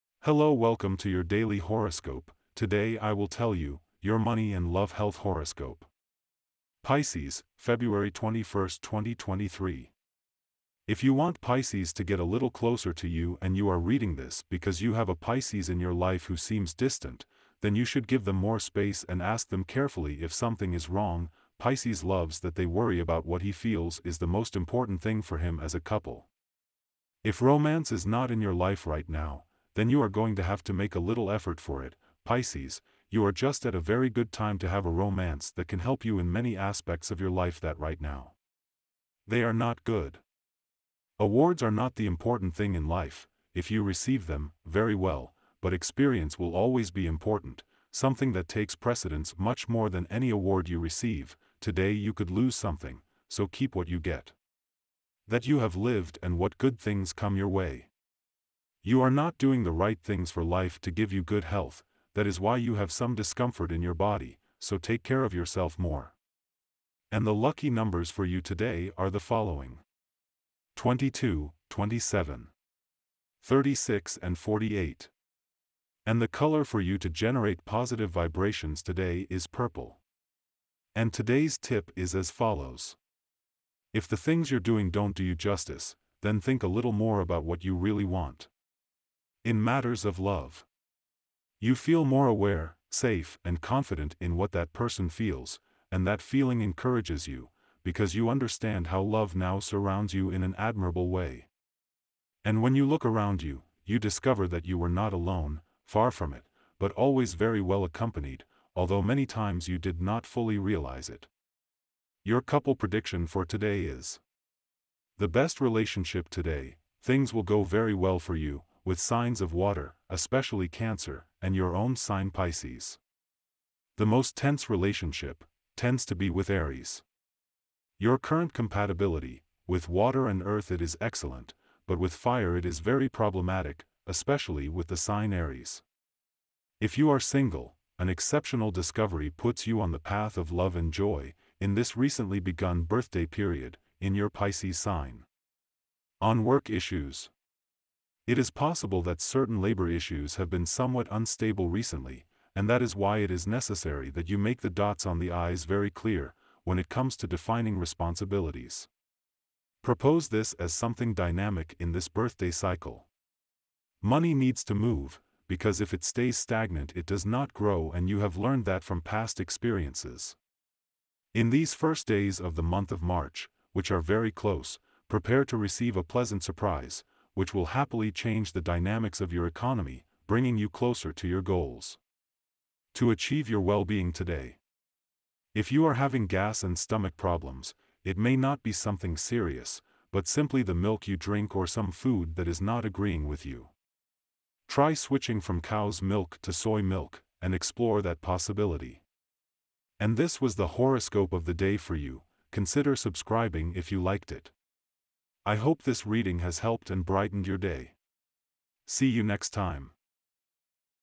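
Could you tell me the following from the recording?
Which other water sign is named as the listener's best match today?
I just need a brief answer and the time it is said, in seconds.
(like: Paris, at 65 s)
Cancer, at 120 s.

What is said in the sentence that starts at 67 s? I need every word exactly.
And the lucky numbers for you today are the following.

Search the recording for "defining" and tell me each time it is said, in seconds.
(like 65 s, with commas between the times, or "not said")
157 s.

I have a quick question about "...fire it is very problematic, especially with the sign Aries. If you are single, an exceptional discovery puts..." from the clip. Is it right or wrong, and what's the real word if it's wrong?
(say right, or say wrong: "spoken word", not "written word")
right.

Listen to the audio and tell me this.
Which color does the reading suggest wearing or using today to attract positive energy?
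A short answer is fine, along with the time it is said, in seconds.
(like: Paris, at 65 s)
Purple, at 79 s.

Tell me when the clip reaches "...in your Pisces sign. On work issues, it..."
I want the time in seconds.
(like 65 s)
143 s.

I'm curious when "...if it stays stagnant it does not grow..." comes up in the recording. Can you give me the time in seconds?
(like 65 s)
165 s.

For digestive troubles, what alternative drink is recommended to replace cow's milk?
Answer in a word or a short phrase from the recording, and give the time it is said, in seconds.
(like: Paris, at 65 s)
Soy milk, at 196 s.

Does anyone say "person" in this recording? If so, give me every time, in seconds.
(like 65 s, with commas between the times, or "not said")
94 s.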